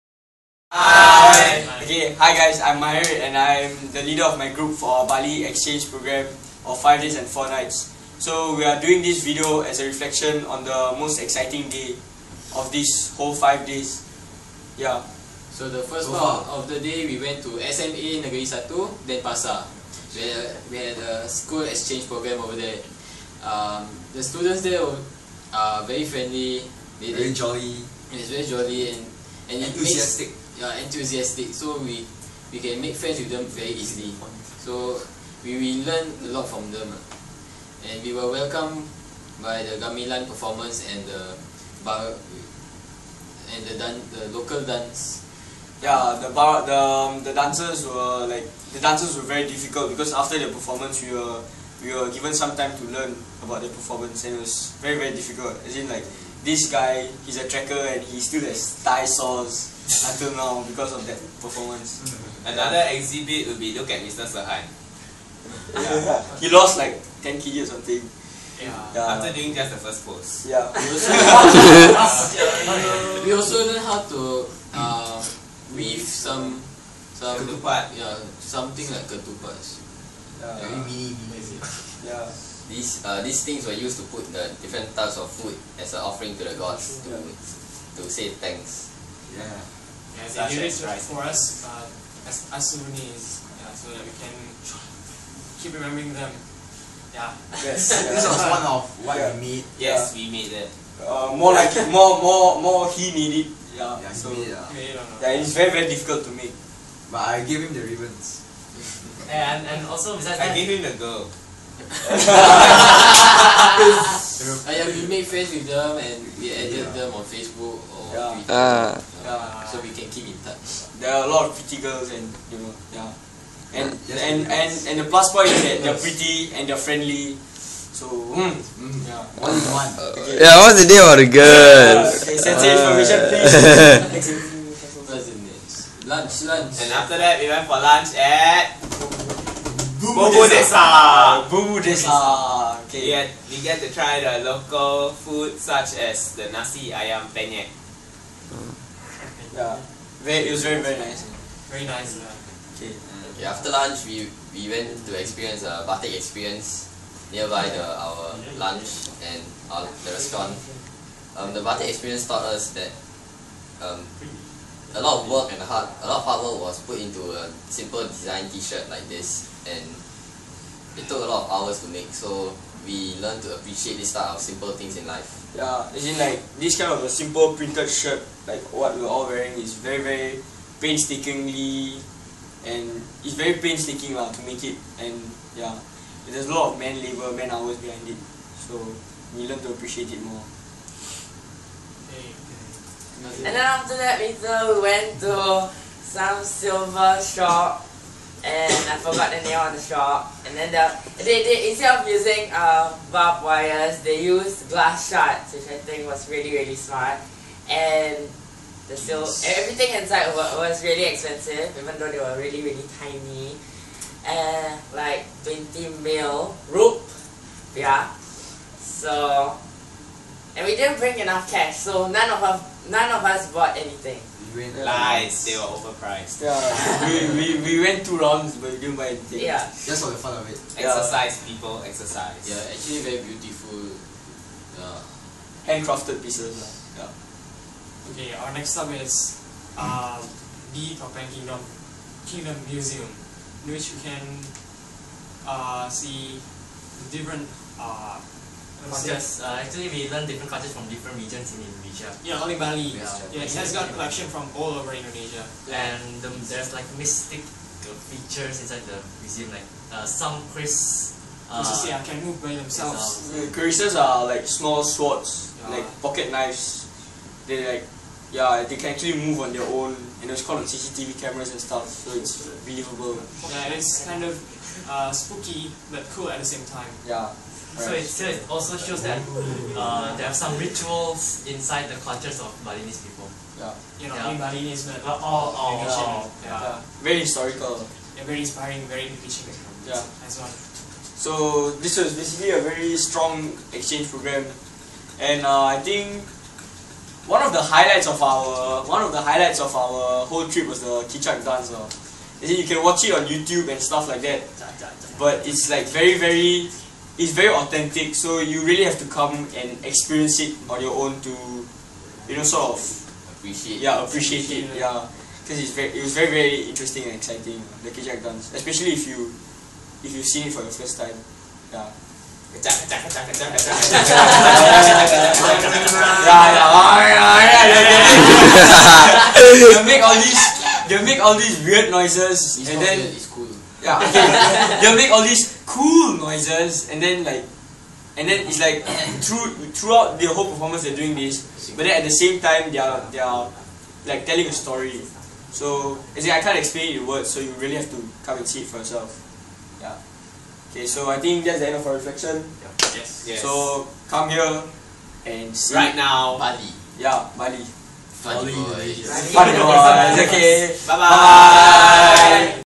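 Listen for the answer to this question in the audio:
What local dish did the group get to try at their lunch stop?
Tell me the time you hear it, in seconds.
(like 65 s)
146 s.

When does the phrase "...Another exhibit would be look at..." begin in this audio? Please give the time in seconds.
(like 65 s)
62 s.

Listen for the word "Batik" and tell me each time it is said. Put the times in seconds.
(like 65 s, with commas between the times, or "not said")
155 s, 161 s.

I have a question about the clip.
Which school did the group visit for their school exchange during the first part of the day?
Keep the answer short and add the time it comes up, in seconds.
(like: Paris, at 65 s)
SMA Negeri Satu, Denpasar, at 17 s.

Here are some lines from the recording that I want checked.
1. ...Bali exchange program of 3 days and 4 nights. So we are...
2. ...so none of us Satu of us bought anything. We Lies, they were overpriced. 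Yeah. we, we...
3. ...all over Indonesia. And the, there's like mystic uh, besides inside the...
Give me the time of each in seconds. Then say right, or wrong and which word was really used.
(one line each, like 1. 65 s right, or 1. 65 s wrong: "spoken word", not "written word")
1. 5 s wrong: "5", not "3"
2. 221 s wrong: "None", not "Satu"
3. 254 s wrong: "features", not "besides".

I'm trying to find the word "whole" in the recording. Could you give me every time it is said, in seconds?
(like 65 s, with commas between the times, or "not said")
13 s, 300 s, 340 s.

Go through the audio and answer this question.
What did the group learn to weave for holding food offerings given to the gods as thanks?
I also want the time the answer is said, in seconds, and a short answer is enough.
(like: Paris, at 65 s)
Ketupat, at 77 s.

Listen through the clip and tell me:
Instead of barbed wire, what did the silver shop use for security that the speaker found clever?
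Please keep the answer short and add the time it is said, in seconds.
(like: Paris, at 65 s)
Glass shards, at 204 s.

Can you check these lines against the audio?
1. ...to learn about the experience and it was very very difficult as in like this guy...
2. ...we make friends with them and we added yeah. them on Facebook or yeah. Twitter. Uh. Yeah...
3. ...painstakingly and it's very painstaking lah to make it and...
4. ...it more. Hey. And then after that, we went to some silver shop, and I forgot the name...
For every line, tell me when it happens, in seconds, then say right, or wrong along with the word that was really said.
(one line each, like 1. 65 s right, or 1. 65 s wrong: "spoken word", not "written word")
1. 52 s wrong: "performance", not "experience"
2. 114 s right
3. 180 s right
4. 190 s right.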